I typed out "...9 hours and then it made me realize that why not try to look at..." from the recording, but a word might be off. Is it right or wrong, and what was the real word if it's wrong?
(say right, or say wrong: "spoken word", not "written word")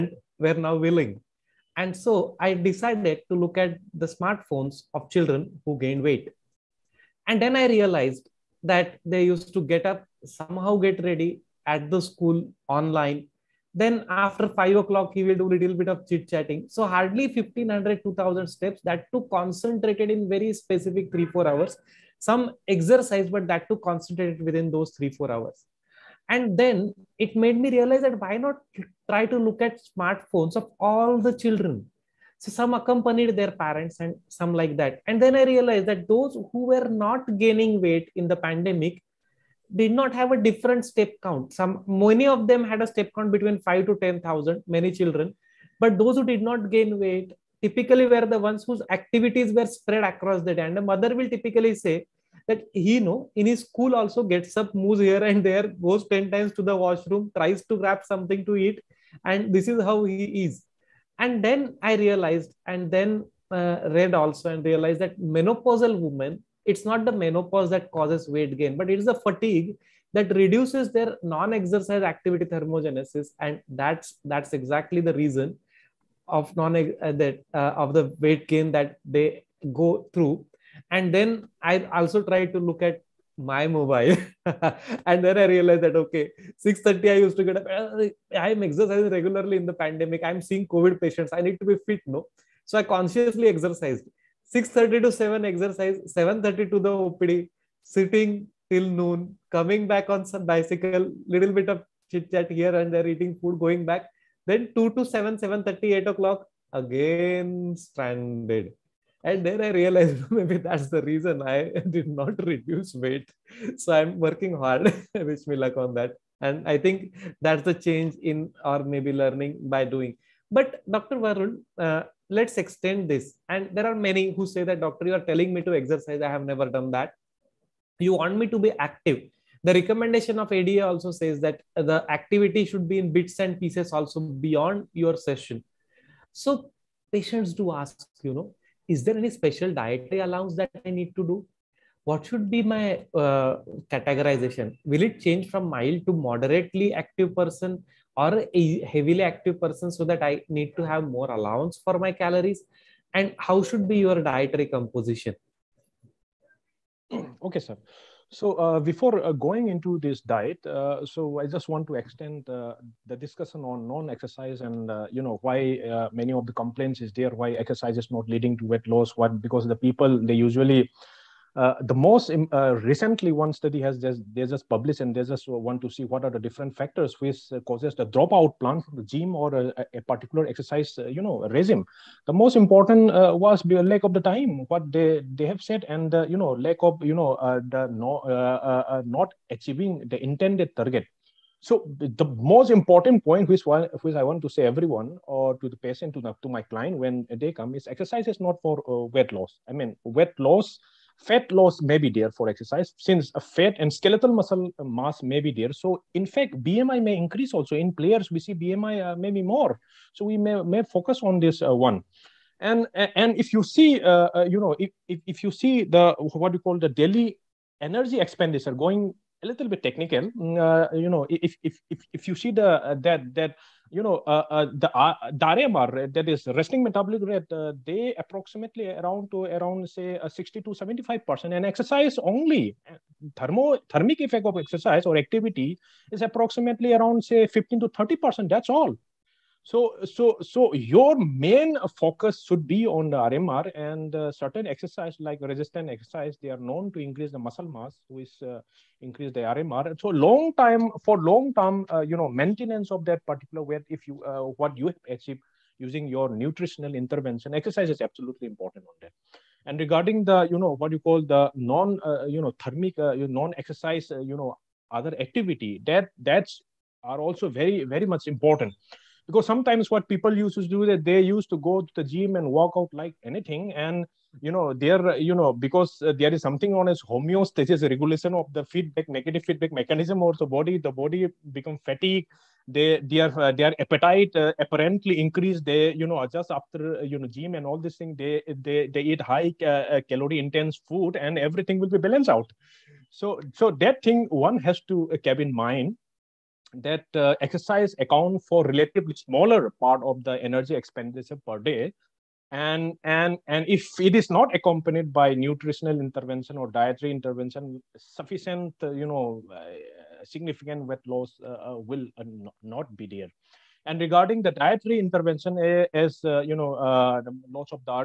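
wrong: "4", not "9".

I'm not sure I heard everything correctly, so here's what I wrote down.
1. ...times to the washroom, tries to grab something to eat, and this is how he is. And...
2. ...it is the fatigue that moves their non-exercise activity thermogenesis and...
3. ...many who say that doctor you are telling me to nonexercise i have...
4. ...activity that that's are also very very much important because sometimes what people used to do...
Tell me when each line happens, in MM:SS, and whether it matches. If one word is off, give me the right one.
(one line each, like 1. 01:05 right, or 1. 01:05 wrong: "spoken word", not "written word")
1. 00:56 right
2. 01:08 wrong: "reduces", not "moves"
3. 02:03 wrong: "exercise", not "nonexercise"
4. 04:25 right.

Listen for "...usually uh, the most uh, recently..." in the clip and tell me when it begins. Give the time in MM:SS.
02:50.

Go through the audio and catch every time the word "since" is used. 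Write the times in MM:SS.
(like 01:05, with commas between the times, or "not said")
03:22.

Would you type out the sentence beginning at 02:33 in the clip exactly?
And how should be your dietary composition?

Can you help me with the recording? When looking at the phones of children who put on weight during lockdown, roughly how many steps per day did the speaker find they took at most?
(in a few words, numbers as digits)
1500 to 2000.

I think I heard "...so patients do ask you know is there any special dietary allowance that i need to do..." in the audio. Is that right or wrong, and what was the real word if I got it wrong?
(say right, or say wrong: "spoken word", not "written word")
right.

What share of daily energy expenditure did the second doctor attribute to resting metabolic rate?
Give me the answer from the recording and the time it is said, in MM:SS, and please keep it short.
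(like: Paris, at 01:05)
60 to 75 percent, at 03:50.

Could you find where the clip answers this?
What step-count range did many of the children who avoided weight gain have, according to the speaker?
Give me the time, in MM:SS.
00:43.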